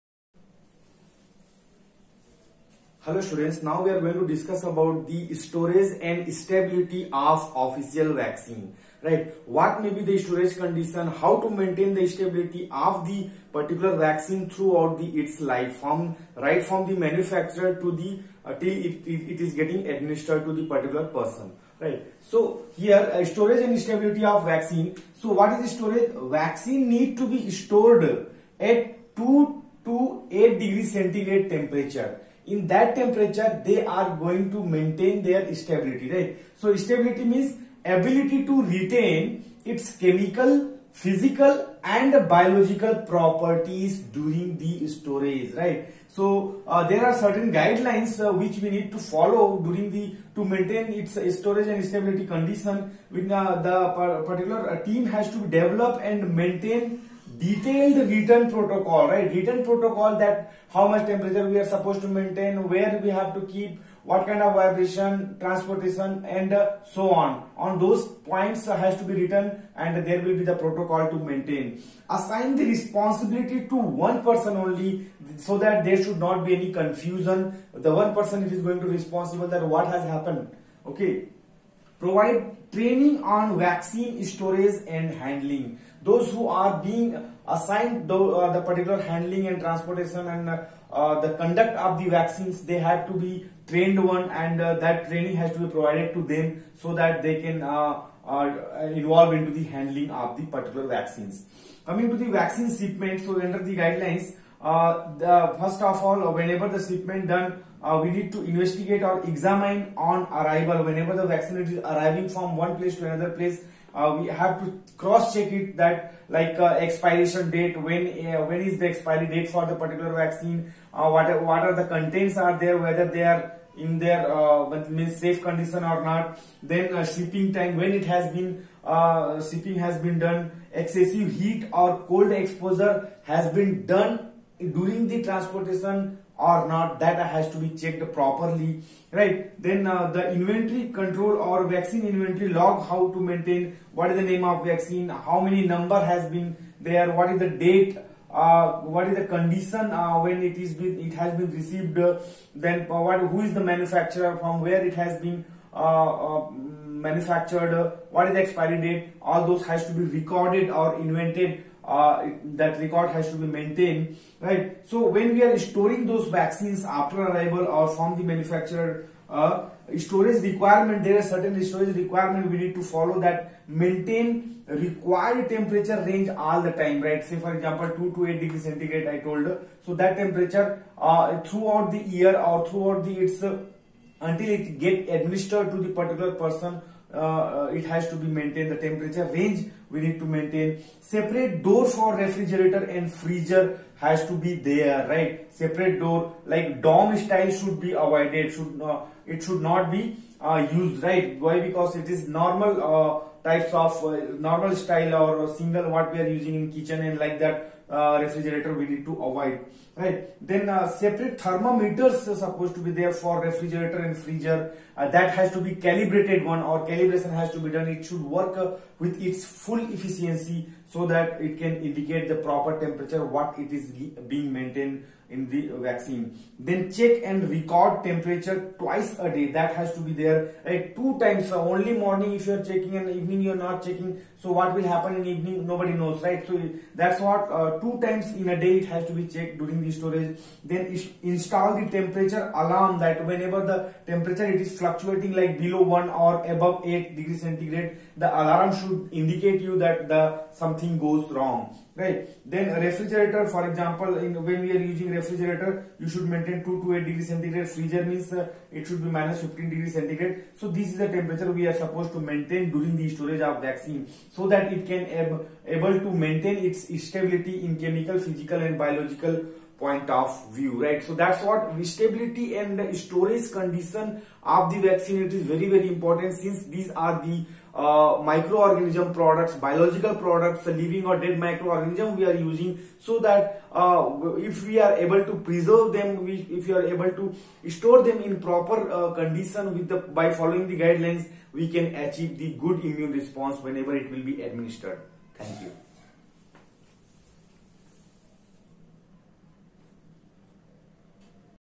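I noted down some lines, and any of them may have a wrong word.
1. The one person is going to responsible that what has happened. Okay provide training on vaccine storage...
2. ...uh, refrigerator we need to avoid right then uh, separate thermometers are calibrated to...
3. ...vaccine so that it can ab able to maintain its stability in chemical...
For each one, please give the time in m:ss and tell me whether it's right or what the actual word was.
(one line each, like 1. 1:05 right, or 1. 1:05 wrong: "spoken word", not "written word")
1. 1:17 right
2. 3:27 wrong: "supposed", not "calibrated"
3. 4:23 right.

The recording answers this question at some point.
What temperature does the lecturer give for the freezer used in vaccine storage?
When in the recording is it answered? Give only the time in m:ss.
4:19.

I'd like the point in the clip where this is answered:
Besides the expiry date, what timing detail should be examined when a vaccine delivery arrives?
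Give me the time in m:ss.
2:07.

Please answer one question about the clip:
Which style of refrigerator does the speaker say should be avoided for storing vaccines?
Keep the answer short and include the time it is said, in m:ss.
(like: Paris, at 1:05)
dorm style, at 3:16.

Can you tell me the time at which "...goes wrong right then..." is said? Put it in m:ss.
4:11.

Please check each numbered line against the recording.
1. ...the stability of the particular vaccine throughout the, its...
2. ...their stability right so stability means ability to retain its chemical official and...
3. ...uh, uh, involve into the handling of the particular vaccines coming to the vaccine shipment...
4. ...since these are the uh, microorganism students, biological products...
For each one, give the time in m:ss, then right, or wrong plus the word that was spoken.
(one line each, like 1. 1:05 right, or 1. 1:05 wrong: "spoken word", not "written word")
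1. 0:11 right
2. 0:35 wrong: "physical", not "official"
3. 1:37 right
4. 4:36 wrong: "products", not "students".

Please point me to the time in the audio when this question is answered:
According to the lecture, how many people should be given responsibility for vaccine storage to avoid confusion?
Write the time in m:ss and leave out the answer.
1:13.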